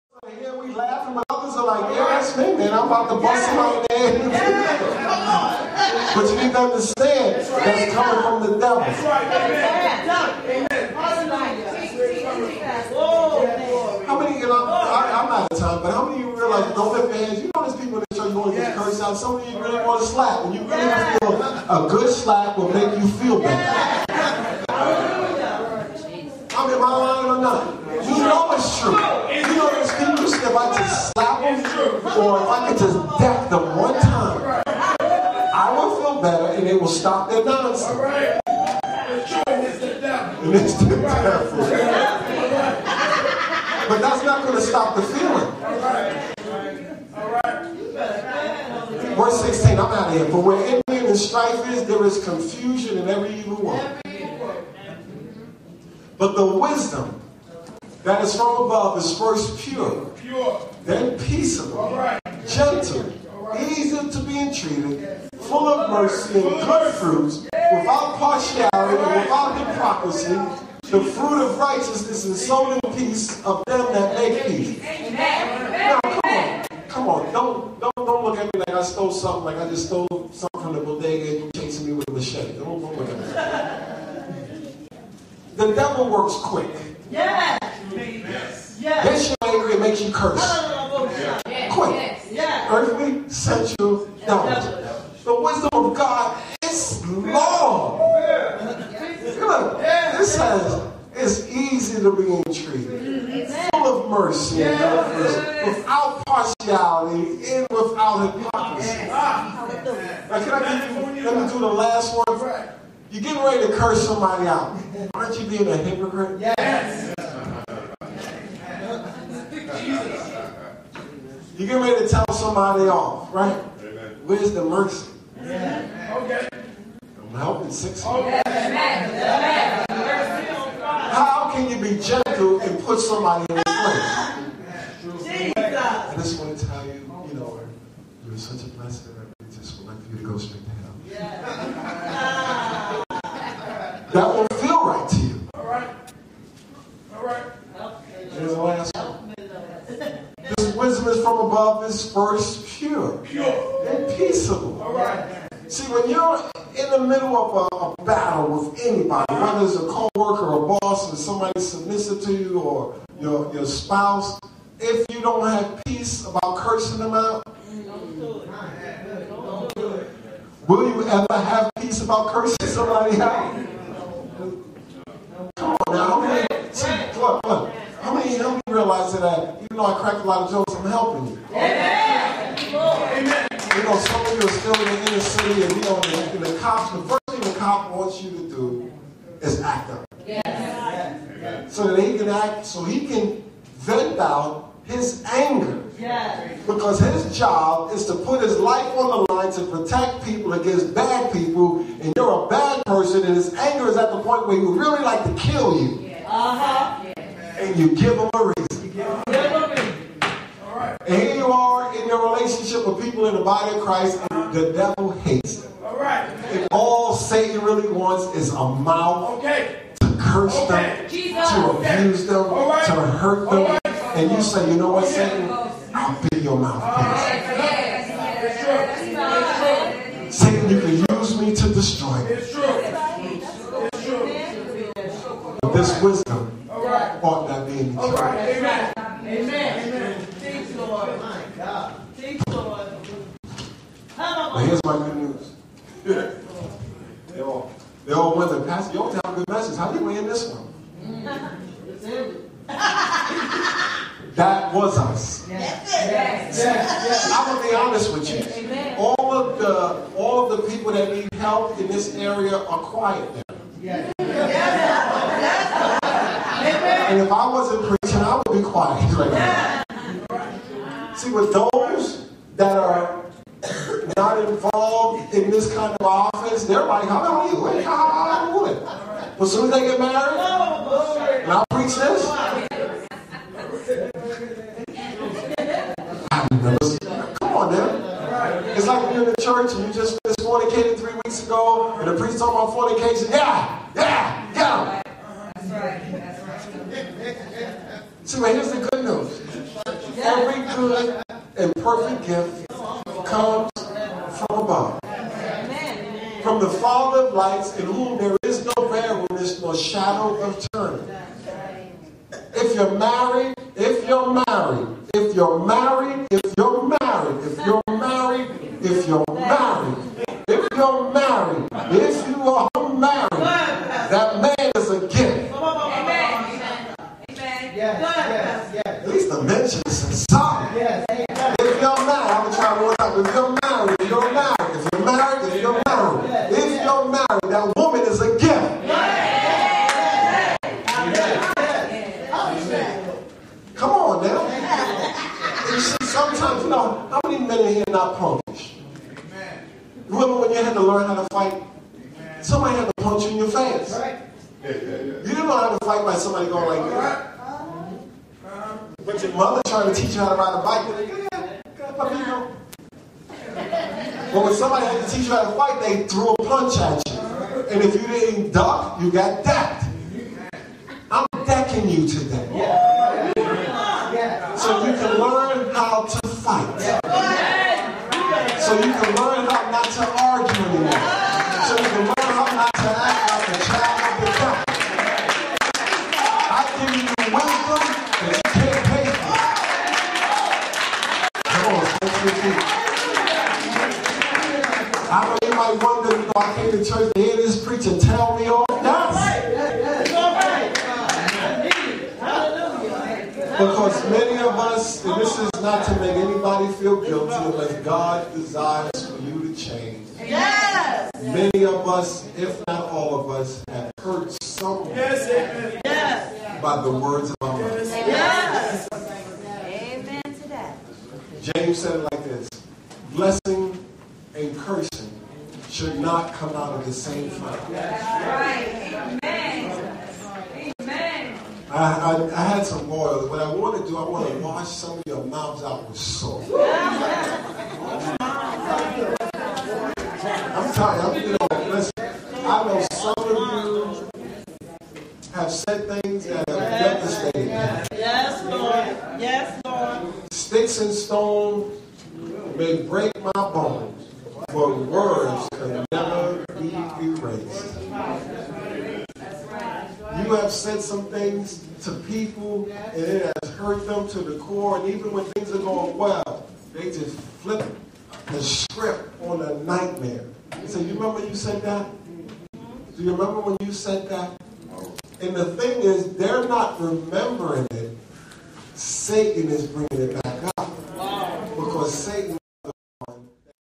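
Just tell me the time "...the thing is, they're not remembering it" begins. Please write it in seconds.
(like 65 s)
475 s.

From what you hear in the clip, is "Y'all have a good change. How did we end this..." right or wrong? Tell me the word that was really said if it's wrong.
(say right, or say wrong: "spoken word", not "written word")
wrong: "message", not "change".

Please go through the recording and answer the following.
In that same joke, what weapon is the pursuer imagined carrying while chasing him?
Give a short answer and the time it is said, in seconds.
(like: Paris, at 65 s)
machete, at 82 s.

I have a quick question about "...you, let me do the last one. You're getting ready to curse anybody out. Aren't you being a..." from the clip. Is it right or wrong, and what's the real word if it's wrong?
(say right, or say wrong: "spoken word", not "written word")
wrong: "somebody", not "anybody".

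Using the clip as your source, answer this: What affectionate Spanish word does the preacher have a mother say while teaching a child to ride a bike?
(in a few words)
papito.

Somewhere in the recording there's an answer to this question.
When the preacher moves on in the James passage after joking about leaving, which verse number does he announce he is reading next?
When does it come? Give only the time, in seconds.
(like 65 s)
49 s.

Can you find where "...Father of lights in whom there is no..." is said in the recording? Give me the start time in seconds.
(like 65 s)
306 s.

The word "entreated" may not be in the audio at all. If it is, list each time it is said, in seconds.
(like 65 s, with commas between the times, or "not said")
64 s, 102 s.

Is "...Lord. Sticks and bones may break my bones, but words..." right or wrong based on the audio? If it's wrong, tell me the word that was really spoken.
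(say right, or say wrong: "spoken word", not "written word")
wrong: "stones", not "bones".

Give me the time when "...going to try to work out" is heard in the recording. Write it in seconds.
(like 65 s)
332 s.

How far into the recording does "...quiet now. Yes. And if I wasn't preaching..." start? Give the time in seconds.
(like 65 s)
262 s.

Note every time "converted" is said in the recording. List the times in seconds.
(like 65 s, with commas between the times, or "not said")
not said.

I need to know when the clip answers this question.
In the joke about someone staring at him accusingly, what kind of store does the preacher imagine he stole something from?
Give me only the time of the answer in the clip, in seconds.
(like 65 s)
80 s.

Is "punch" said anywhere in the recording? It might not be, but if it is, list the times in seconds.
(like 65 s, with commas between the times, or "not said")
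353 s, 366 s.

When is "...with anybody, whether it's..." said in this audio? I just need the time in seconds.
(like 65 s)
158 s.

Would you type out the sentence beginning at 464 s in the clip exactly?
And even when things are going well, they just flip the script on a nightmare.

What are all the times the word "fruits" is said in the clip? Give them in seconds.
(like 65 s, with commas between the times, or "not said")
66 s, 71 s.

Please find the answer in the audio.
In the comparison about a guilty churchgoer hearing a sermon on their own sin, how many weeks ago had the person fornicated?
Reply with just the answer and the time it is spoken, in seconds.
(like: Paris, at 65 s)
3, at 290 s.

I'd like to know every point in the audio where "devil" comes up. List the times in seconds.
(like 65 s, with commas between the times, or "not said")
8 s, 40 s, 85 s, 214 s, 384 s.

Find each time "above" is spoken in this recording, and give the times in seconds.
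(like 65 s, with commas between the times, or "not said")
58 s, 151 s.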